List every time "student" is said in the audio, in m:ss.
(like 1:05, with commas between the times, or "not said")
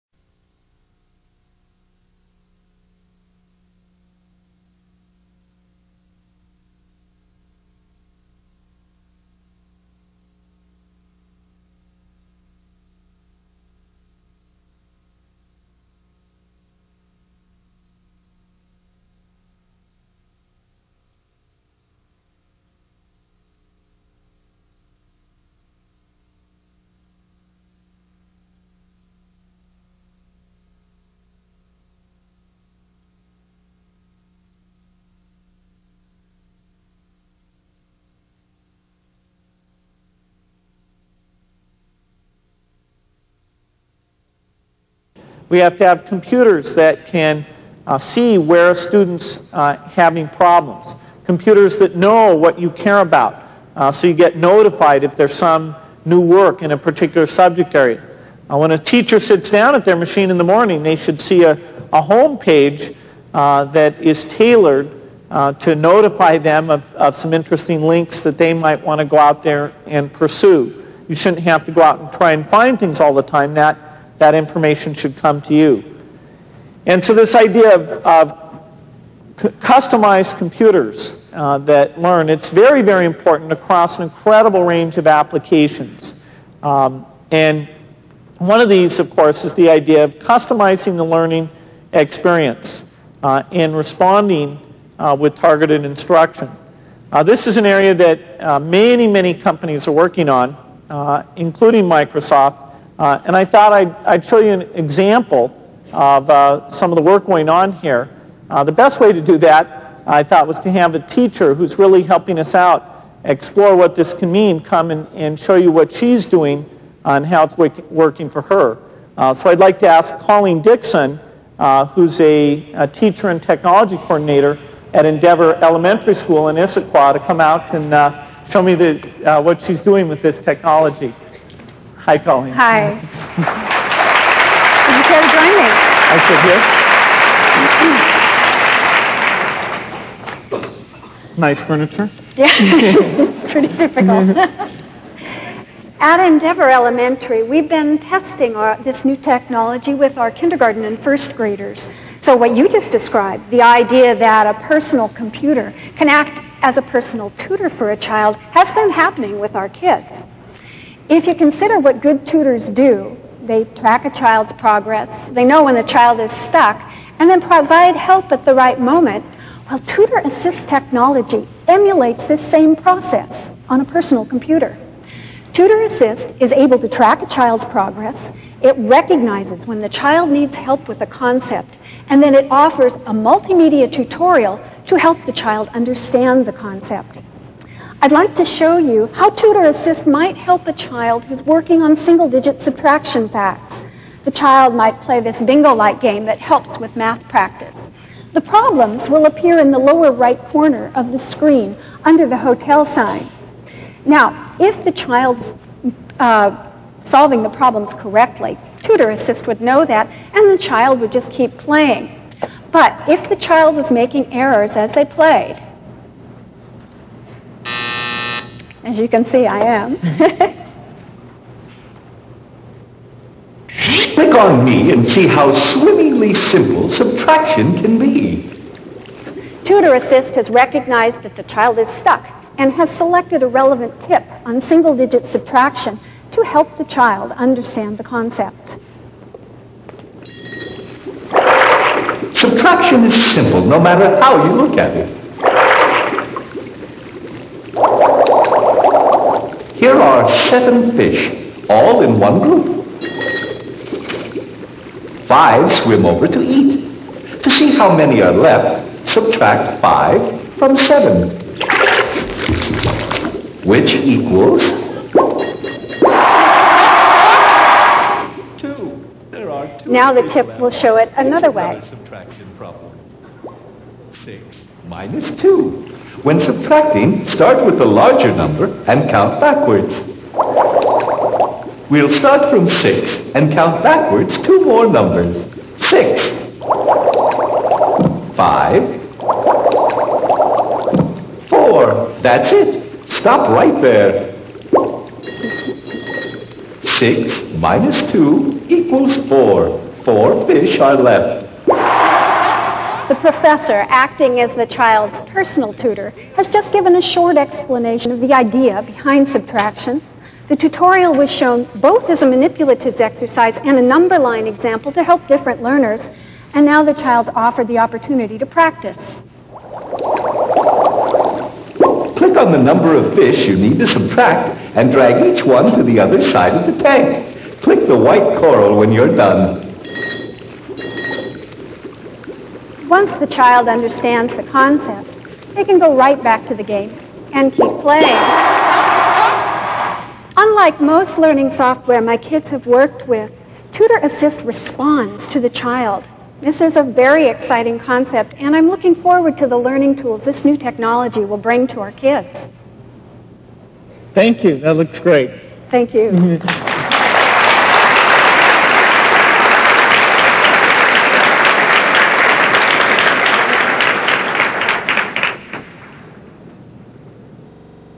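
0:48.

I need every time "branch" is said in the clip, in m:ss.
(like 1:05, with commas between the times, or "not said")
not said.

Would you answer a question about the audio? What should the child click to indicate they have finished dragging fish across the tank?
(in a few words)
the white coral.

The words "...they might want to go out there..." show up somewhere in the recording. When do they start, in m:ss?
1:08.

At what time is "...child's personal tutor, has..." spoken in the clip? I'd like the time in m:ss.
5:04.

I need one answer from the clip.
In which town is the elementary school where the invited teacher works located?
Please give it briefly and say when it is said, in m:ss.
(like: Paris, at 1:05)
Issaquah, at 2:06.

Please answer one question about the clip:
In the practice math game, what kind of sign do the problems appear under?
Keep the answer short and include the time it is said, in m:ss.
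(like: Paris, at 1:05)
hotel sign, at 3:22.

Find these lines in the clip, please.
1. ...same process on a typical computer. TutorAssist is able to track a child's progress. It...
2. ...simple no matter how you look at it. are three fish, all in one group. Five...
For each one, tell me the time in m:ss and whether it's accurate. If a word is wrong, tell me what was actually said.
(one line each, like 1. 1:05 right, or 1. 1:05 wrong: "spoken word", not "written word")
1. 2:52 wrong: "personal", not "typical"
2. 4:03 wrong: "seven", not "three".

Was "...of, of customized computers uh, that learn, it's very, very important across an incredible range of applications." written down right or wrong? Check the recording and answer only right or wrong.
right.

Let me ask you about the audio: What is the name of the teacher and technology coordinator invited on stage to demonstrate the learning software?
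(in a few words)
Colleen Dixon.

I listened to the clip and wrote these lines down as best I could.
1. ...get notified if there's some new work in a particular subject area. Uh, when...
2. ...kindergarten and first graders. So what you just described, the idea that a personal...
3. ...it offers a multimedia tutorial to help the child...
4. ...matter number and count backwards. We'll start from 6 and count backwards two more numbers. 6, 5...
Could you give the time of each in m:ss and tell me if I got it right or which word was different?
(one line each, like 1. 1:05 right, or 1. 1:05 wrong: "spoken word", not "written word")
1. 0:54 right
2. 2:30 right
3. 3:02 right
4. 4:37 wrong: "larger", not "matter".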